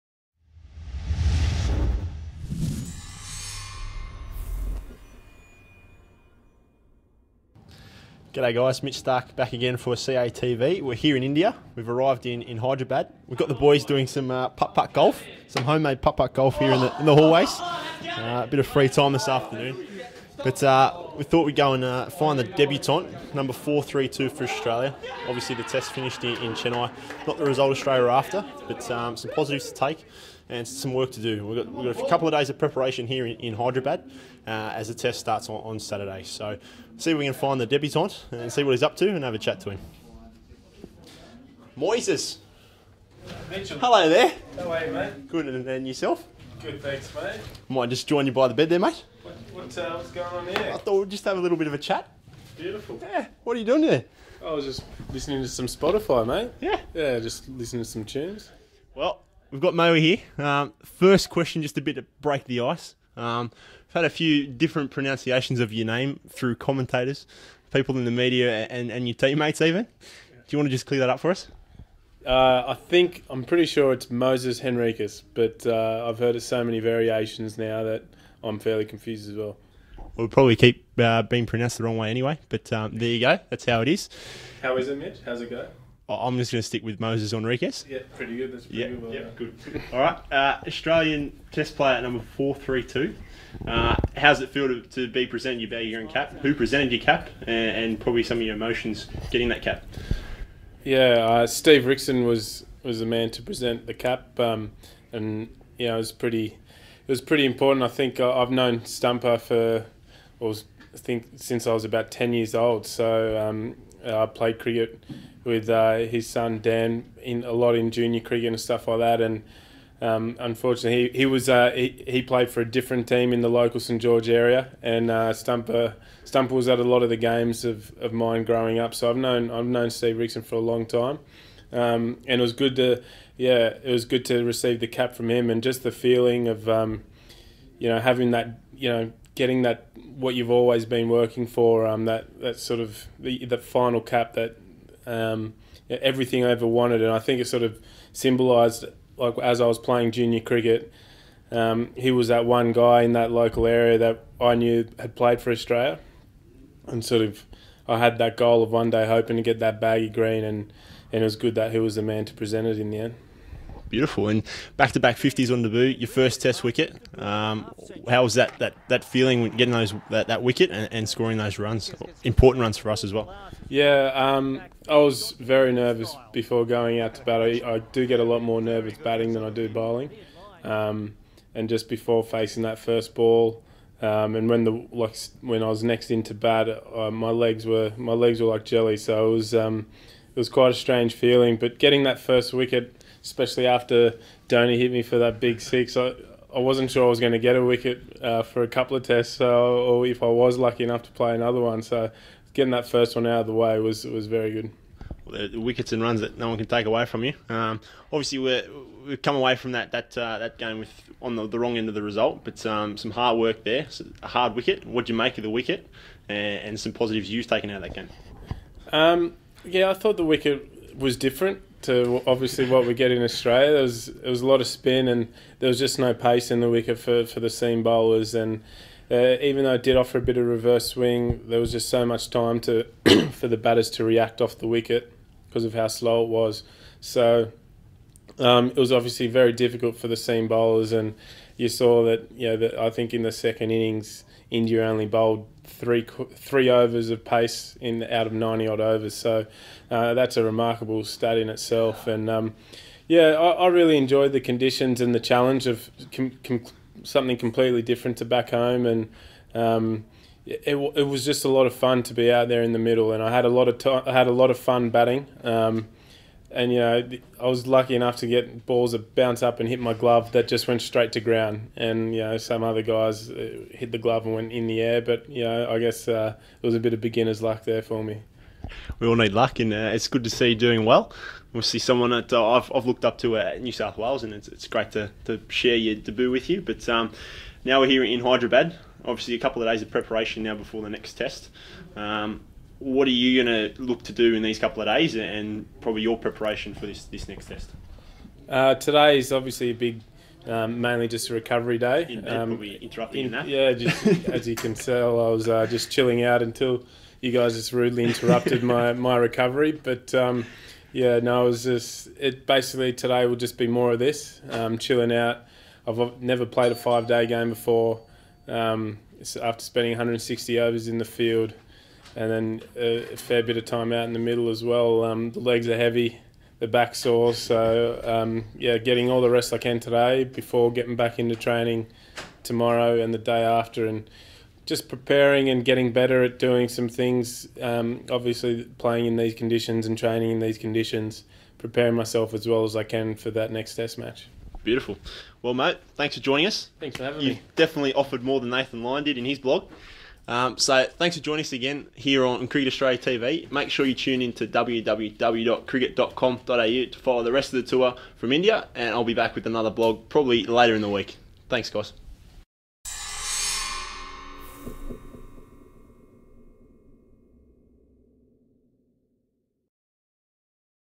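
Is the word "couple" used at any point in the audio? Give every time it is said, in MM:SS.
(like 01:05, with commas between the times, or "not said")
00:32, 03:18, 04:49, 04:54.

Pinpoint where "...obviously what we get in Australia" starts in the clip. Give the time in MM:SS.
03:42.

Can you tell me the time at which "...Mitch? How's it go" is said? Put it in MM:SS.
01:24.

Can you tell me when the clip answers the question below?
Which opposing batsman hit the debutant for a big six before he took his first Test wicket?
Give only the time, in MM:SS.
03:14.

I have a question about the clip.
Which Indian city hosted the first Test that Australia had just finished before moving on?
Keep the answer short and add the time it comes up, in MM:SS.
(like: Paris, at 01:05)
Chennai, at 00:26.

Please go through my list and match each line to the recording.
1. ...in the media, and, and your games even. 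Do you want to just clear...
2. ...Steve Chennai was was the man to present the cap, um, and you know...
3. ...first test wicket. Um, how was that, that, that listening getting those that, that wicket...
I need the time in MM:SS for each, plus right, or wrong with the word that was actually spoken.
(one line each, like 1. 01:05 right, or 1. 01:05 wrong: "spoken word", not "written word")
1. 01:07 wrong: "teammates", not "games"
2. 01:41 wrong: "Rixon", not "Chennai"
3. 02:46 wrong: "feeling", not "listening".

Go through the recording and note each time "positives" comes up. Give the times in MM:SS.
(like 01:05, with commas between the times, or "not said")
00:29, 03:36.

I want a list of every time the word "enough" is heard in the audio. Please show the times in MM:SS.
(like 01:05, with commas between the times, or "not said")
03:20, 04:27.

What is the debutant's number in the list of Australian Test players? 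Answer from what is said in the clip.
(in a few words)
432.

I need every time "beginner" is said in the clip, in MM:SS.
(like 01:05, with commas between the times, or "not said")
04:37.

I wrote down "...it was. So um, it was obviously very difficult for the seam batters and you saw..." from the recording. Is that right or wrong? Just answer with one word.
wrong.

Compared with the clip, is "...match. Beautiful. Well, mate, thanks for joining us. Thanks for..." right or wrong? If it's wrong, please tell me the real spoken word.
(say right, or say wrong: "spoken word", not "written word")
right.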